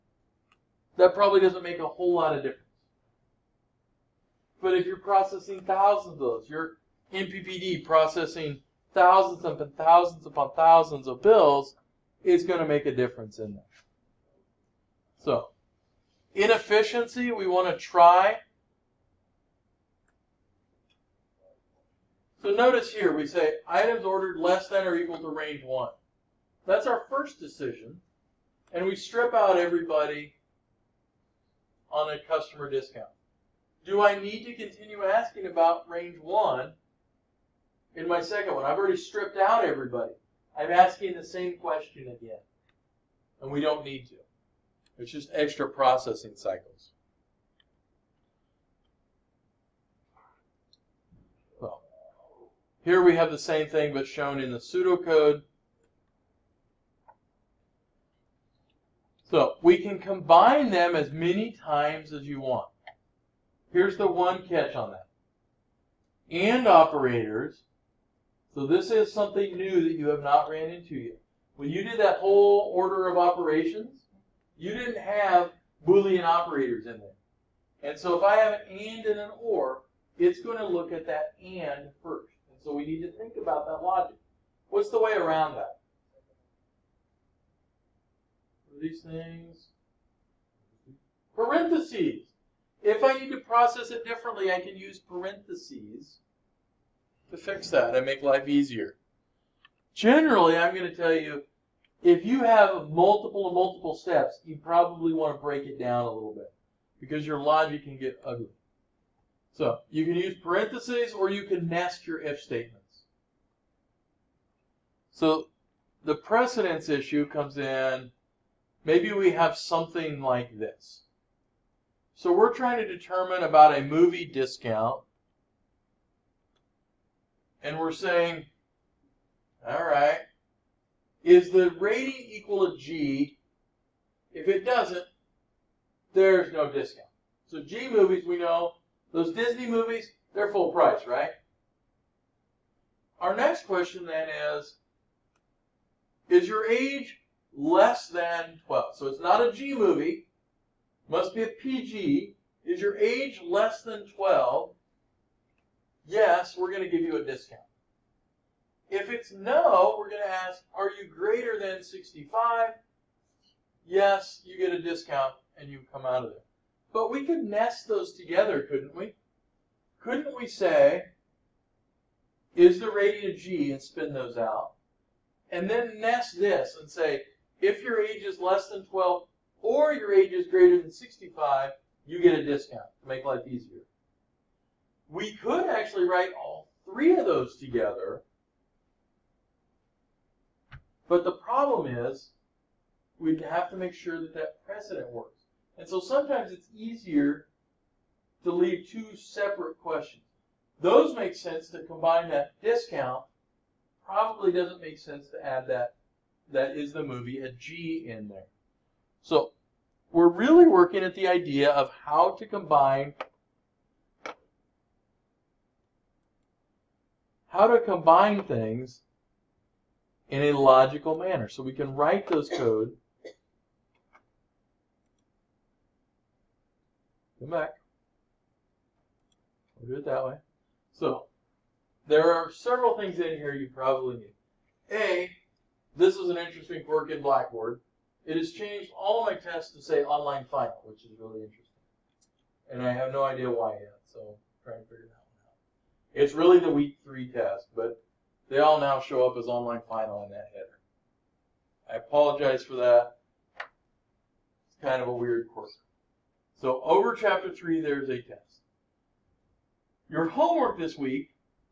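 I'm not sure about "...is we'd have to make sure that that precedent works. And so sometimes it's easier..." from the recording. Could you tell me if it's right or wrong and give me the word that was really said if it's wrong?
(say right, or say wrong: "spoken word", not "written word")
right.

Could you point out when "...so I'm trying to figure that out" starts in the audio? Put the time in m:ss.
4:04.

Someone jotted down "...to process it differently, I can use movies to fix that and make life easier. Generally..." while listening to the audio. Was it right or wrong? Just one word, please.
wrong.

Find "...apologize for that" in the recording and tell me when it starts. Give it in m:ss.
4:11.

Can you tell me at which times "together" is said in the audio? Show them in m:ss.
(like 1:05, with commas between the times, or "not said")
2:48, 3:07.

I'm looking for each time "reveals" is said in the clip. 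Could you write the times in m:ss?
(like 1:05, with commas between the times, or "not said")
not said.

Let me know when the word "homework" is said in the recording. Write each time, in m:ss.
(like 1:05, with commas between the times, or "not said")
4:20.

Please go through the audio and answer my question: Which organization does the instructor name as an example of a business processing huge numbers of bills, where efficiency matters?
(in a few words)
NPPD.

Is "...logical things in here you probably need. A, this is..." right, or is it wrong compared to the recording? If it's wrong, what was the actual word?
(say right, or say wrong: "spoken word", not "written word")
wrong: "several", not "logical".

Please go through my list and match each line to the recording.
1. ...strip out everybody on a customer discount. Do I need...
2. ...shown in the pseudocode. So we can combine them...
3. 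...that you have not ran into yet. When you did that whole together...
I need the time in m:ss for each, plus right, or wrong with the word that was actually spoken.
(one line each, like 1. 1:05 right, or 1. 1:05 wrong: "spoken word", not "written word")
1. 0:28 right
2. 0:54 right
3. 1:09 wrong: "order", not "together".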